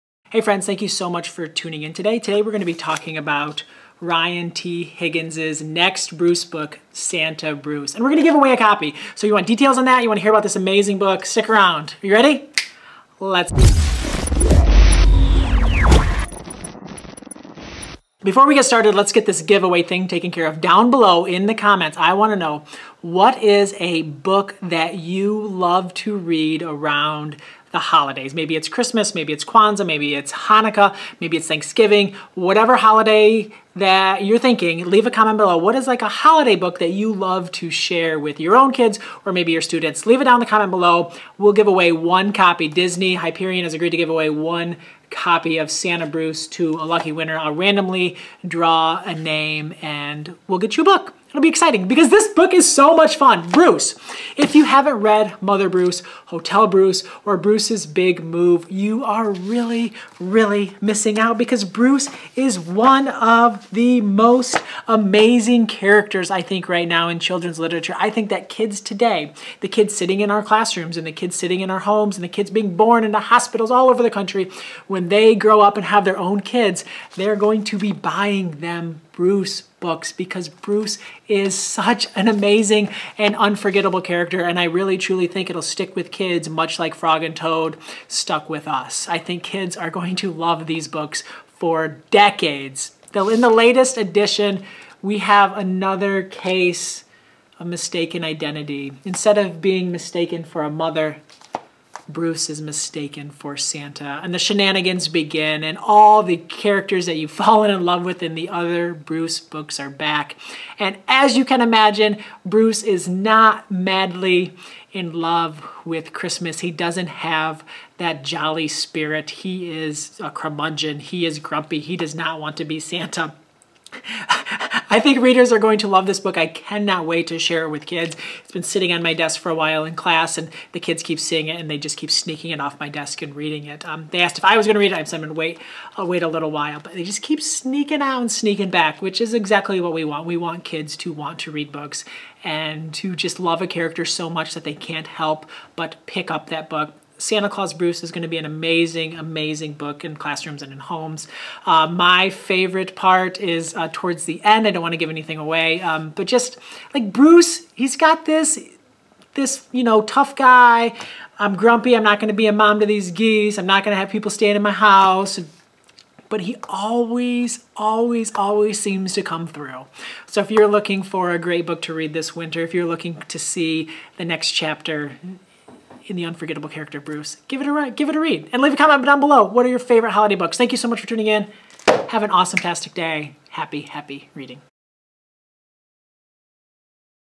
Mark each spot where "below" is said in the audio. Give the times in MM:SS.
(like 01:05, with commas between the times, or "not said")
00:20, 00:35, 00:40, 02:59.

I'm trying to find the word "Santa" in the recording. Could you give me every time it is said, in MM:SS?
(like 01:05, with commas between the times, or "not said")
00:06, 00:45, 01:43, 02:02, 02:27.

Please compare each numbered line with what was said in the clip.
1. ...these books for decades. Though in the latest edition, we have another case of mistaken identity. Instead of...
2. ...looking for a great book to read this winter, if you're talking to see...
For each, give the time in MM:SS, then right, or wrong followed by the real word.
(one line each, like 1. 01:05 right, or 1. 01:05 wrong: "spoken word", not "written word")
1. 01:30 right
2. 02:50 wrong: "looking", not "talking".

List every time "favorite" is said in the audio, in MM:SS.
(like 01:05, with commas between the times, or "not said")
02:32, 02:59.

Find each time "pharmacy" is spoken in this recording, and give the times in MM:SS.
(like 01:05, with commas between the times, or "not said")
not said.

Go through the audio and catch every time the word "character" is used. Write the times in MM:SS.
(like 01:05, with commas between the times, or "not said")
01:05, 01:24, 01:46, 02:23, 02:56.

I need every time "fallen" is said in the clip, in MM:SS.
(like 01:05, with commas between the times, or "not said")
01:47.